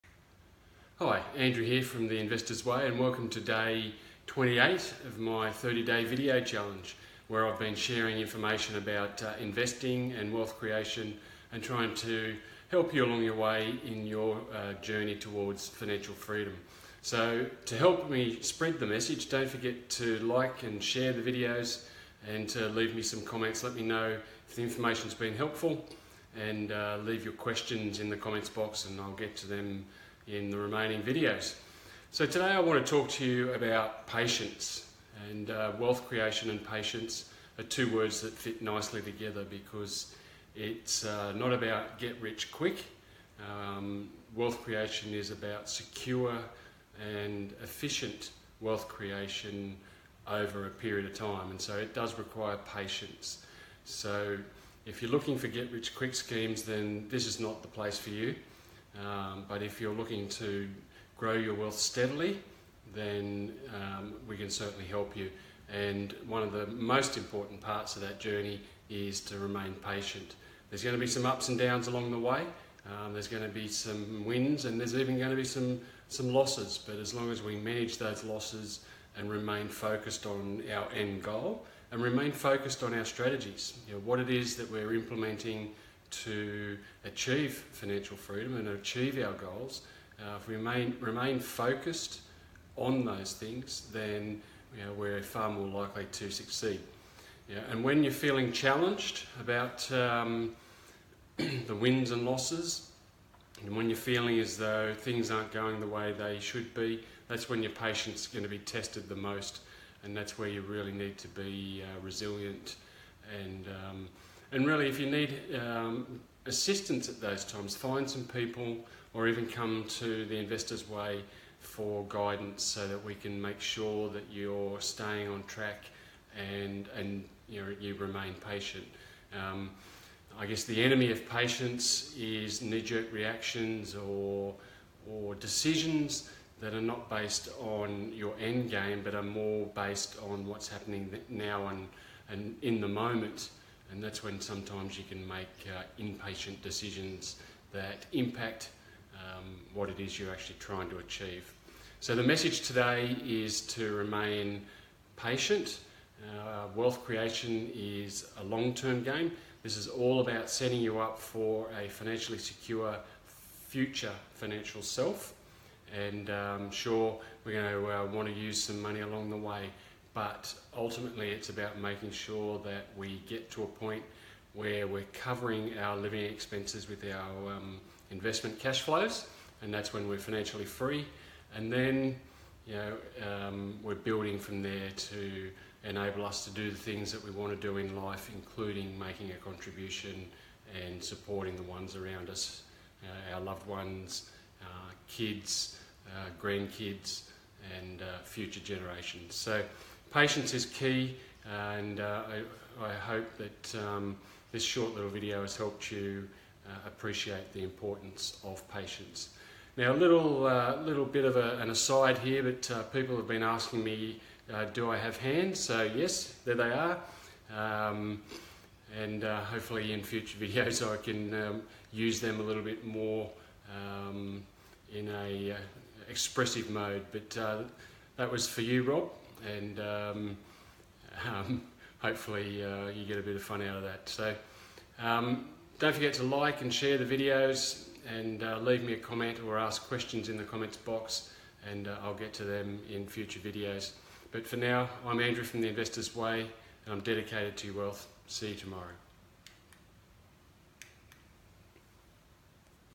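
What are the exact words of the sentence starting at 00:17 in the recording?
So, to help me spread the message, don't forget to like and share the videos and to leave me some comments.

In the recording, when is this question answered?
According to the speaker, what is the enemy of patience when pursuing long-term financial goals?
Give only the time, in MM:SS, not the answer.
02:12.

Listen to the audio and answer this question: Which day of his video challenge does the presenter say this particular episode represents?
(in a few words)
28.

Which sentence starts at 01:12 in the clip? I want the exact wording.
Um, there's going to be some wins and there's even going to be some, some losses.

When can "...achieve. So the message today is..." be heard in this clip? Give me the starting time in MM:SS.
02:30.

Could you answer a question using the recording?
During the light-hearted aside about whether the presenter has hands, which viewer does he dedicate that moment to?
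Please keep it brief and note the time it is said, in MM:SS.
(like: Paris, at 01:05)
Rob, at 03:48.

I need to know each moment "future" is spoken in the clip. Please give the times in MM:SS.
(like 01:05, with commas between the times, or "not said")
02:43, 03:18, 03:40, 04:03.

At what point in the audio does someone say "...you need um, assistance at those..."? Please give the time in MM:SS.
01:54.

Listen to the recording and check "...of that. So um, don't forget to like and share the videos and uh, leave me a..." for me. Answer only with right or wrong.
right.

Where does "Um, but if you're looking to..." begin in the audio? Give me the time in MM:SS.
00:58.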